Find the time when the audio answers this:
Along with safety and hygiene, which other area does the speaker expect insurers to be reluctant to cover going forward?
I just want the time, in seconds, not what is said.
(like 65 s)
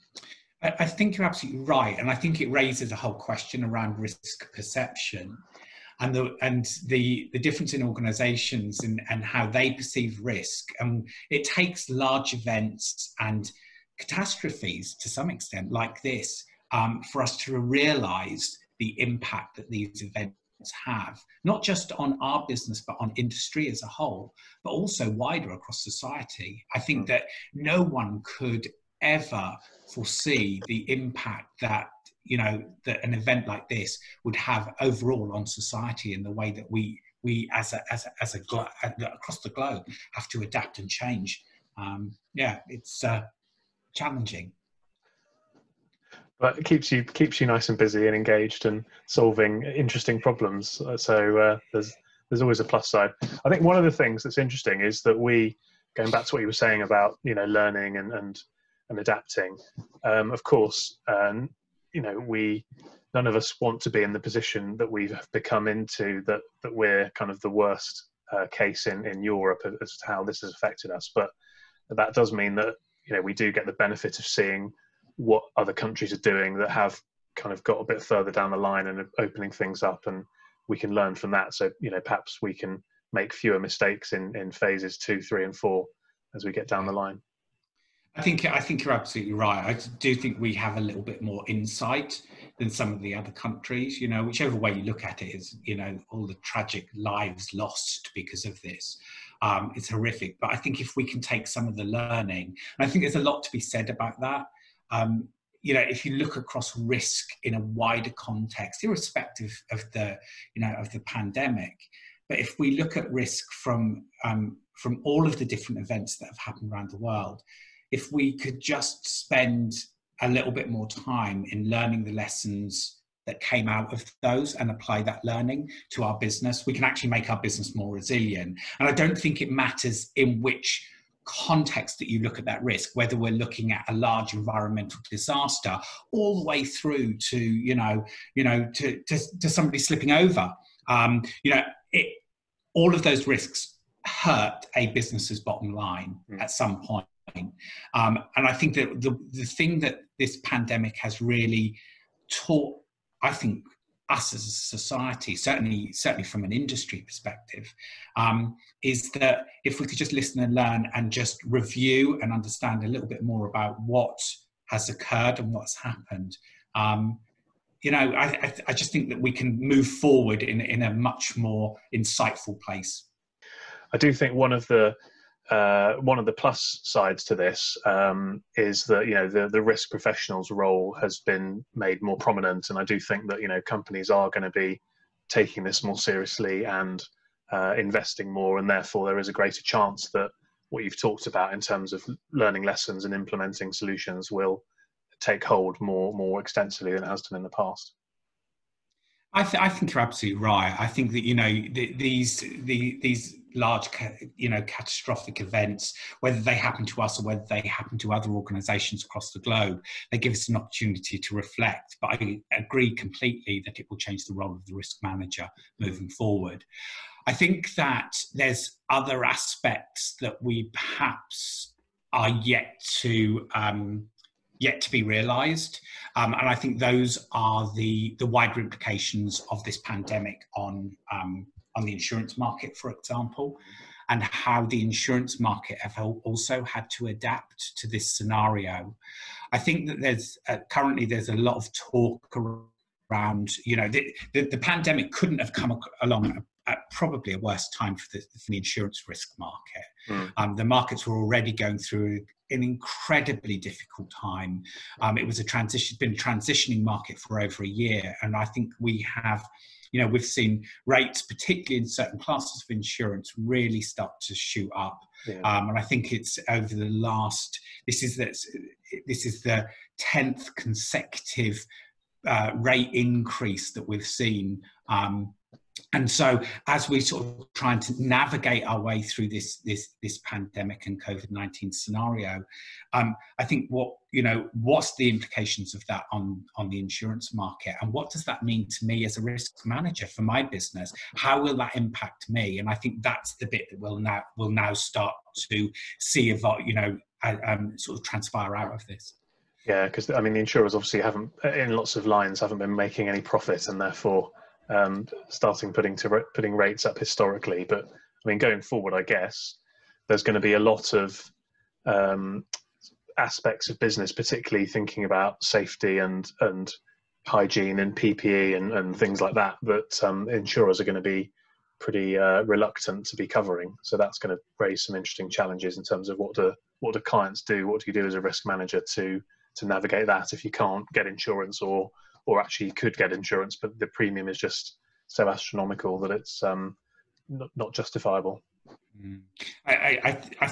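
317 s.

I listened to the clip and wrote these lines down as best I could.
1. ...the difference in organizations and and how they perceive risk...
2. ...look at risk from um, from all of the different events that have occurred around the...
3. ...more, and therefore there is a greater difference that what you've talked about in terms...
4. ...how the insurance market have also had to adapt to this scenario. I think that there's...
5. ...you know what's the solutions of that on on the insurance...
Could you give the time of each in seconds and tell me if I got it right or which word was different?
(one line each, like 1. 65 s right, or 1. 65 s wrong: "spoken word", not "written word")
1. 7 s right
2. 112 s wrong: "happened", not "occurred"
3. 188 s wrong: "chance", not "difference"
4. 234 s right
5. 284 s wrong: "implications", not "solutions".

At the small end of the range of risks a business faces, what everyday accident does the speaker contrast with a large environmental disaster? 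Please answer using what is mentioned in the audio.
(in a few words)
somebody slipping over.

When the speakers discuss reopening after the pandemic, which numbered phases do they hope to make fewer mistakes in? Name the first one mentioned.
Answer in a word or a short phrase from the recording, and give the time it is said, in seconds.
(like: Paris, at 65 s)
phase 2, at 84 s.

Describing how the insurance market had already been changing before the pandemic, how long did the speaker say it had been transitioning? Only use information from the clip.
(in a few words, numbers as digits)
over a year.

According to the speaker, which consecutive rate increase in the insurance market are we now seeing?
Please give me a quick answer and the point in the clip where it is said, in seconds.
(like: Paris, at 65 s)
10th, at 269 s.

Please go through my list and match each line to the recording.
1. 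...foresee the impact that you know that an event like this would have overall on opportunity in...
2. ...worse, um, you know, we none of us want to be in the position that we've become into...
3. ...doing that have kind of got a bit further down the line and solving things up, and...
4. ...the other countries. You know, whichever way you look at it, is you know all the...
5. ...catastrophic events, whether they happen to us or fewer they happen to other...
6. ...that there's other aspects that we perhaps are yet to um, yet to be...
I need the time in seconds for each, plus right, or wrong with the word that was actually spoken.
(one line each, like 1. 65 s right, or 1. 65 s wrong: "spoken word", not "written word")
1. 29 s wrong: "society", not "opportunity"
2. 60 s wrong: "course", not "worse"
3. 76 s wrong: "opening", not "solving"
4. 92 s right
5. 204 s wrong: "whether", not "fewer"
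6. 217 s right.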